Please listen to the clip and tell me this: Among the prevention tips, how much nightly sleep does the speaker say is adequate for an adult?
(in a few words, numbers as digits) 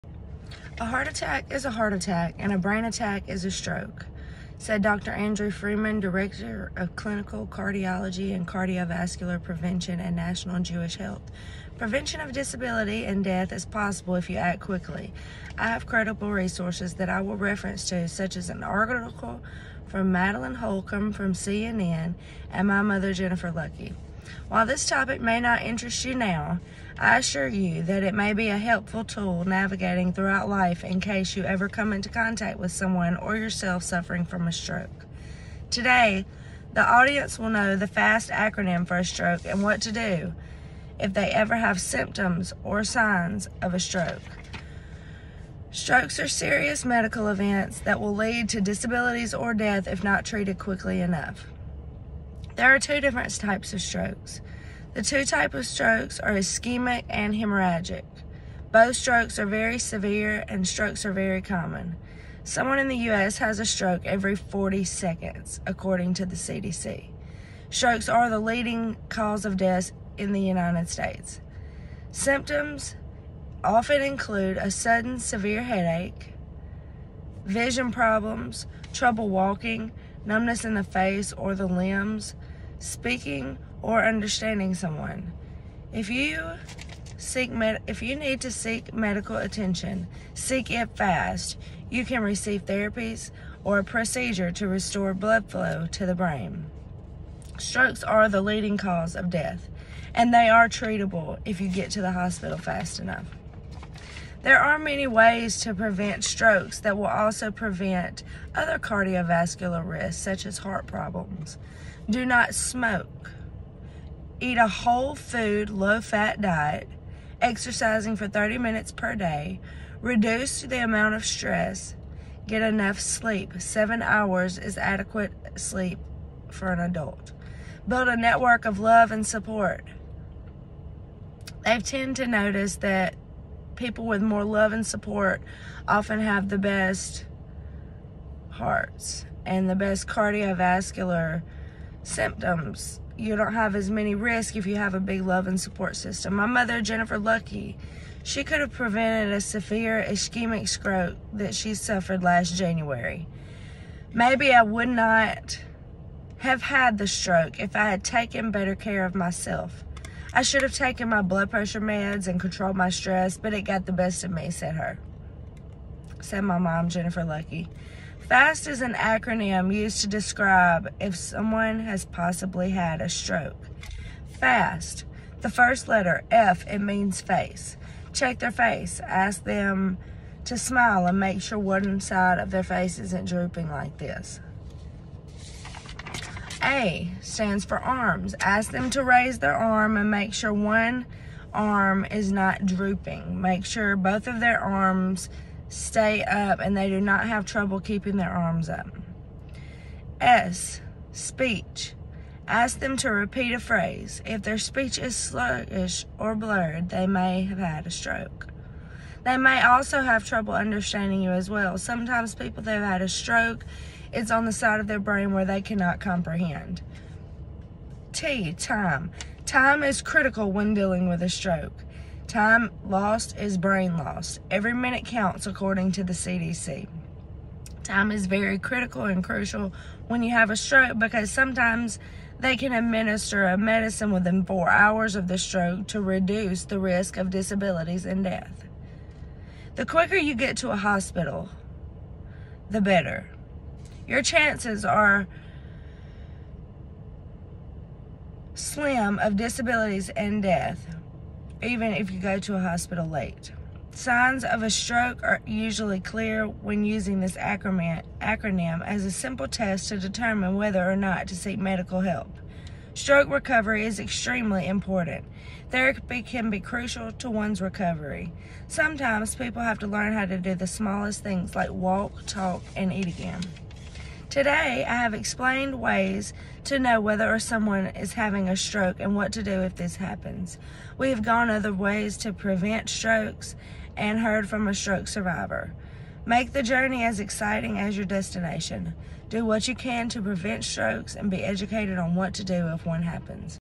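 7 hours.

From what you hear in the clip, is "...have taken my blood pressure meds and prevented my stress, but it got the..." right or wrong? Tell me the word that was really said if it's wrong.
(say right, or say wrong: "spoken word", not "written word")
wrong: "controlled", not "prevented".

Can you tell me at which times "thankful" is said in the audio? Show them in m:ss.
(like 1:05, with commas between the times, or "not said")
not said.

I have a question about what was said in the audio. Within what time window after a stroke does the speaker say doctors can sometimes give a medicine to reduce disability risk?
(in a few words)
4 hours.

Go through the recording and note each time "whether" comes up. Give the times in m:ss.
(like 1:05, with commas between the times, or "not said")
4:20, 4:36.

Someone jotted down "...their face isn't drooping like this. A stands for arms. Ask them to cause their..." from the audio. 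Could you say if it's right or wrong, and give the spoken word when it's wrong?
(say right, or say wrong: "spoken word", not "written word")
wrong: "raise", not "cause".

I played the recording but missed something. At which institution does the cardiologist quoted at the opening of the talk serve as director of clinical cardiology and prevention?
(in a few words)
National Jewish Health.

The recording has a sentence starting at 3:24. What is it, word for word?
If their speech is sluggish or blurred, they may have had a stroke.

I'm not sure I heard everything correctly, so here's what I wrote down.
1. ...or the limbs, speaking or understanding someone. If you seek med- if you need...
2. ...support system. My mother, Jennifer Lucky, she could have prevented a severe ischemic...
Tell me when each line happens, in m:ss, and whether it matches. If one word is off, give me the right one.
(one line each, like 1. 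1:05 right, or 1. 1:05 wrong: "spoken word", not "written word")
1. 1:21 right
2. 2:25 right.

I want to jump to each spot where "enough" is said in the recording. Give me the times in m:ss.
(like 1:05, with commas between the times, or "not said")
0:51, 1:42, 2:02.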